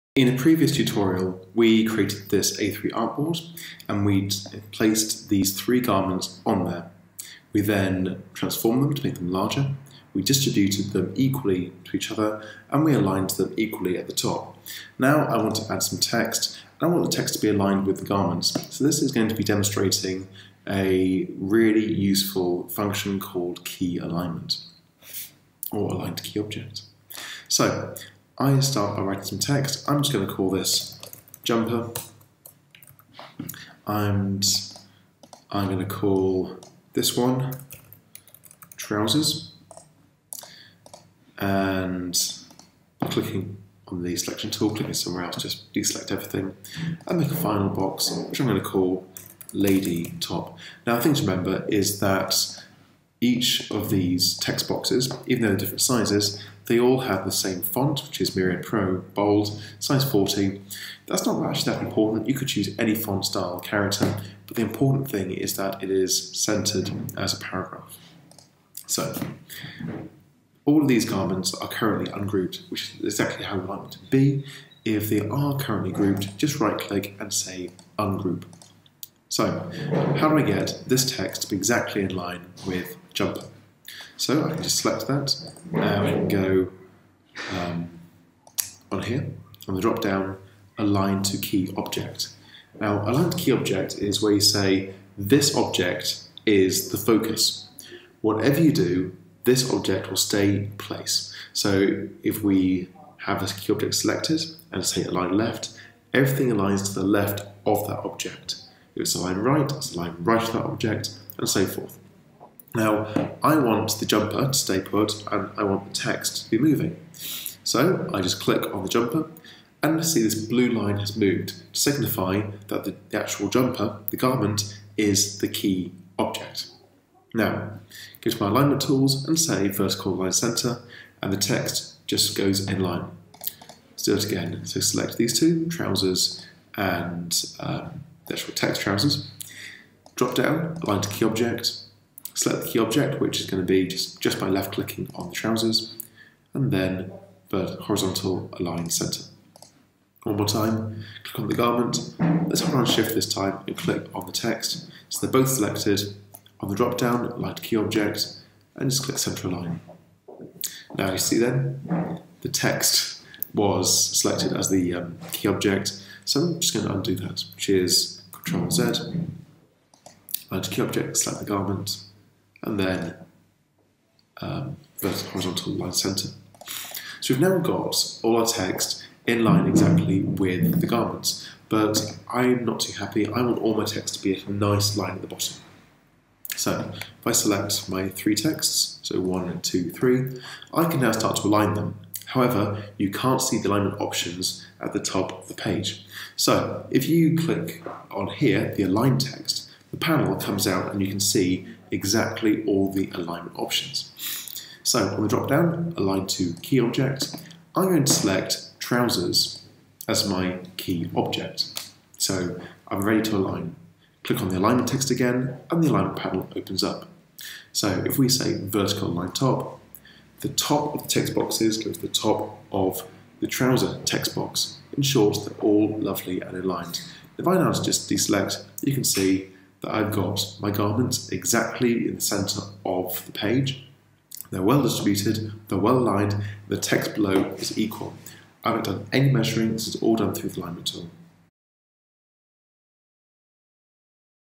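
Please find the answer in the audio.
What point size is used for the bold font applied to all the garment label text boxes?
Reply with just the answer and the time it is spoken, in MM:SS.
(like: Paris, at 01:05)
40, at 00:59.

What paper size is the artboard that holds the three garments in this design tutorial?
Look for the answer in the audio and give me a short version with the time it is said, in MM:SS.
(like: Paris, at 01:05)
A3, at 00:02.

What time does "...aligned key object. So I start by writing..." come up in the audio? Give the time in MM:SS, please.
00:25.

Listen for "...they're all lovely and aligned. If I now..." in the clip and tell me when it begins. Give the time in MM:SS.
03:45.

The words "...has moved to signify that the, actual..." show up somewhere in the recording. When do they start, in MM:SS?
02:00.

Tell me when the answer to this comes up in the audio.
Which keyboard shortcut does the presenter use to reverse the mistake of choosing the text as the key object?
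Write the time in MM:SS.
02:48.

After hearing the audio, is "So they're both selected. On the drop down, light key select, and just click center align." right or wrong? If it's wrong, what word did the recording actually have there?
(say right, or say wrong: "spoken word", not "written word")
wrong: "object", not "select".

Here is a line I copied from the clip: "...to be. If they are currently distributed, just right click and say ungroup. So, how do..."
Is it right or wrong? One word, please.
wrong.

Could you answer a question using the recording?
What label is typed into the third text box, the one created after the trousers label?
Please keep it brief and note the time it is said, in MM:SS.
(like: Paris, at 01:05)
lady top, at 00:49.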